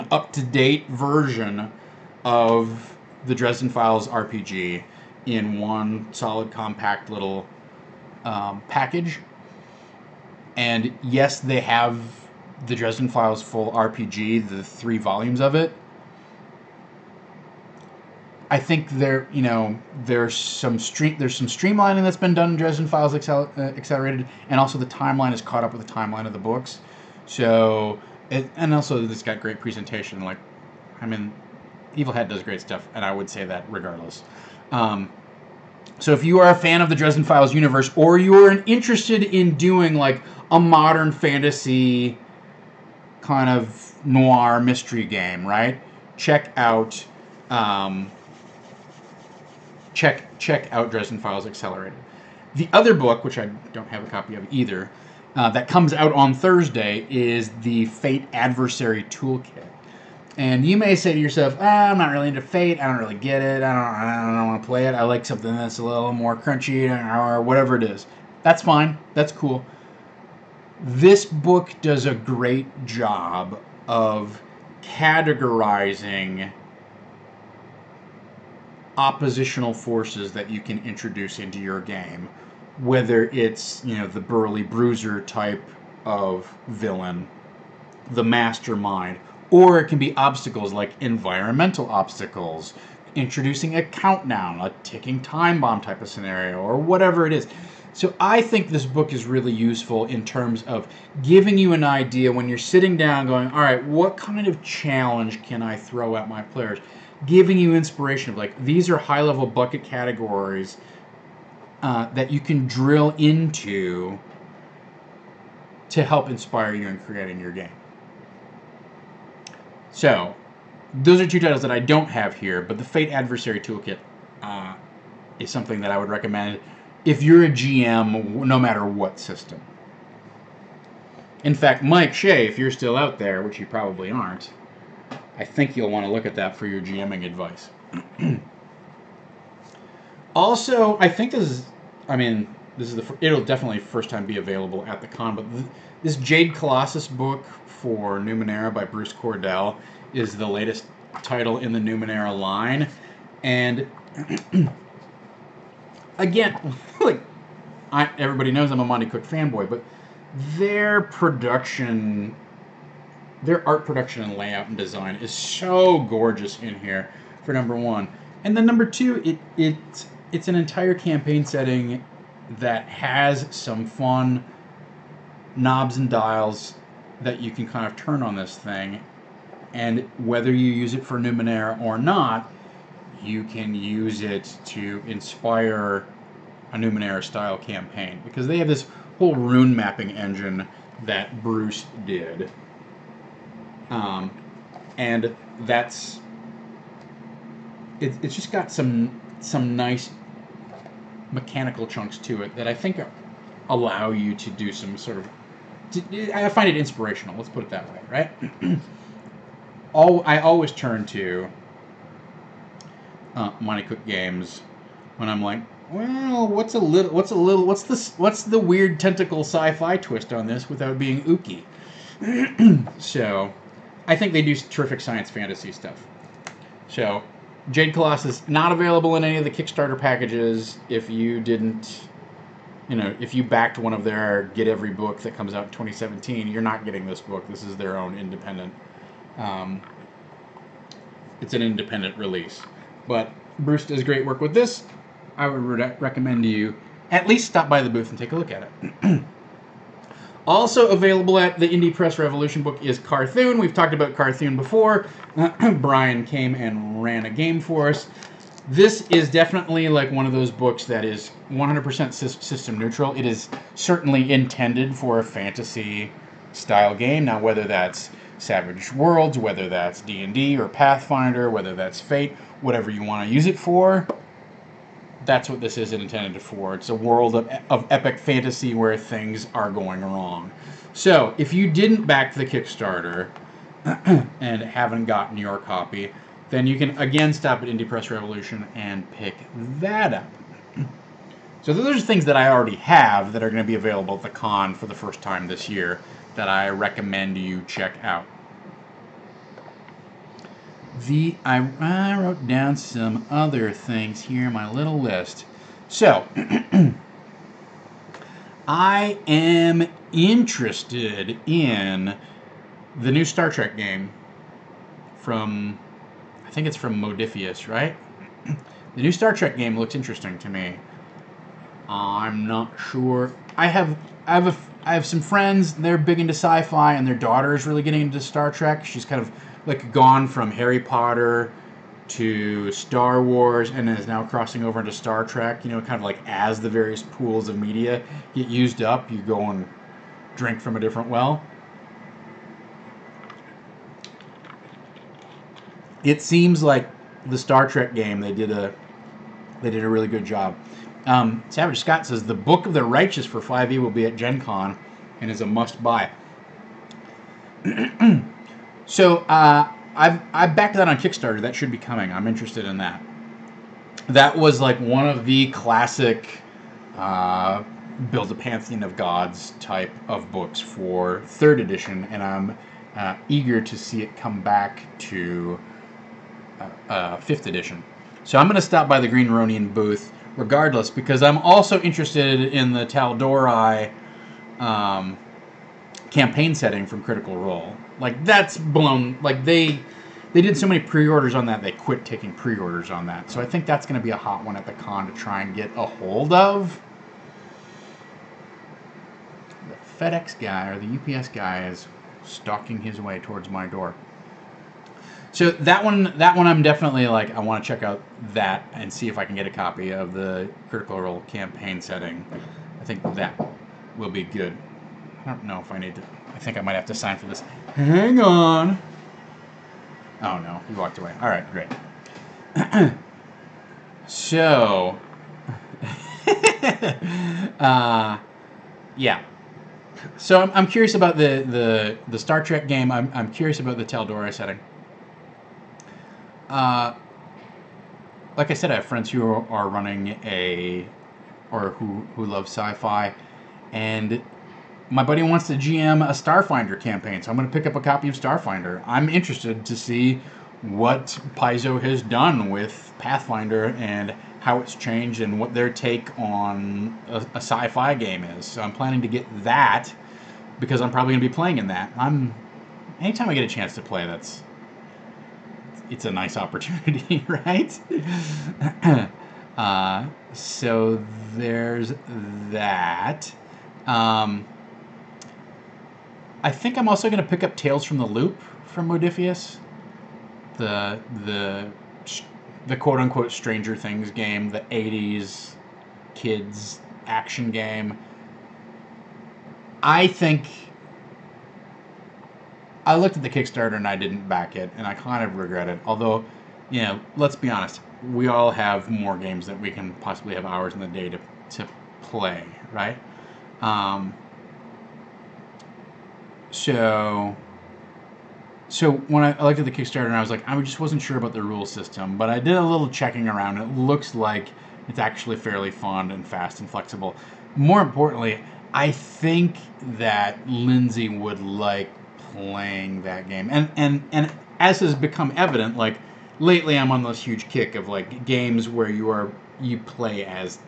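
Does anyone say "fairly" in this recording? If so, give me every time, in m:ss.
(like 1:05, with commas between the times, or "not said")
8:35.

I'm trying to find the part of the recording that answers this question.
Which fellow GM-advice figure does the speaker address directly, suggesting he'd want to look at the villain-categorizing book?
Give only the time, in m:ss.
2:11.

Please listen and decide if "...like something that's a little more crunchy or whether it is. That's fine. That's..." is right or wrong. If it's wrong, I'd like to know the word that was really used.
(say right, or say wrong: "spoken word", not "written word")
wrong: "whatever", not "whether".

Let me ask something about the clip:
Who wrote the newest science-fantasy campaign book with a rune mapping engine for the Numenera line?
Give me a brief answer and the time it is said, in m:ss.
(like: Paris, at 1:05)
Bruce Cordell, at 2:28.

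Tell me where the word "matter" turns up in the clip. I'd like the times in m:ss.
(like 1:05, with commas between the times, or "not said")
2:08.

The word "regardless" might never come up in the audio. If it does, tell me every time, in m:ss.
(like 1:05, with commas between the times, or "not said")
0:33, 6:20.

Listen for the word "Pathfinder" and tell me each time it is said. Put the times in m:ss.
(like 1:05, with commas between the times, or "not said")
4:30, 7:32.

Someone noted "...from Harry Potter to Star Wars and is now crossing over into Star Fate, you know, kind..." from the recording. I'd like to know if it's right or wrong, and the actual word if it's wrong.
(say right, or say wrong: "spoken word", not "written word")
wrong: "Trek", not "Fate".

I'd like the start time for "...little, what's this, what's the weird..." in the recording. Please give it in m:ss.
3:37.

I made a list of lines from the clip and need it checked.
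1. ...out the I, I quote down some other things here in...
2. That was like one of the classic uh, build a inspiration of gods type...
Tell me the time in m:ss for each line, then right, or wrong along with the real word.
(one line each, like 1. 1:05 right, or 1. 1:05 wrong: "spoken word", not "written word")
1. 4:58 wrong: "wrote", not "quote"
2. 6:04 wrong: "pantheon", not "inspiration".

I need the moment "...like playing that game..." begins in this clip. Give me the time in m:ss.
8:41.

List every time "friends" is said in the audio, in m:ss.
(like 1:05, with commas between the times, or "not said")
5:25, 7:18.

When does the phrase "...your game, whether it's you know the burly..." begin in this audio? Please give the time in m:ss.
1:21.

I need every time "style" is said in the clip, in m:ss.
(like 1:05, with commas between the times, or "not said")
3:07, 4:26.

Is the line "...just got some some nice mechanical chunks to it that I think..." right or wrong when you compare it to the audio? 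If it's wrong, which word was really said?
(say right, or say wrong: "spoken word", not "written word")
right.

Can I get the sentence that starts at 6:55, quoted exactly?
I don't know if I need to I think I might have to sign for this.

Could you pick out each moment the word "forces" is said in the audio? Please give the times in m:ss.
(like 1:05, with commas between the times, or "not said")
1:19.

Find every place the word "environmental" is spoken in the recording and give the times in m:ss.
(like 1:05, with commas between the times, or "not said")
1:31.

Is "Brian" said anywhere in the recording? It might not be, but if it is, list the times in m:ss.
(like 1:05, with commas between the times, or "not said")
4:15.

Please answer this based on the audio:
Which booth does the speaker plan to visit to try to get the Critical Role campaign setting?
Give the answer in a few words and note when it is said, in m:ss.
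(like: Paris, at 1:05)
Green Ronin, at 6:19.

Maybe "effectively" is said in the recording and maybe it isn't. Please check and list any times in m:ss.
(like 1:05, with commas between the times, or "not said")
not said.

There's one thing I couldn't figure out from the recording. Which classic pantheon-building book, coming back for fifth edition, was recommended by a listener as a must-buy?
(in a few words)
Book of the Righteous.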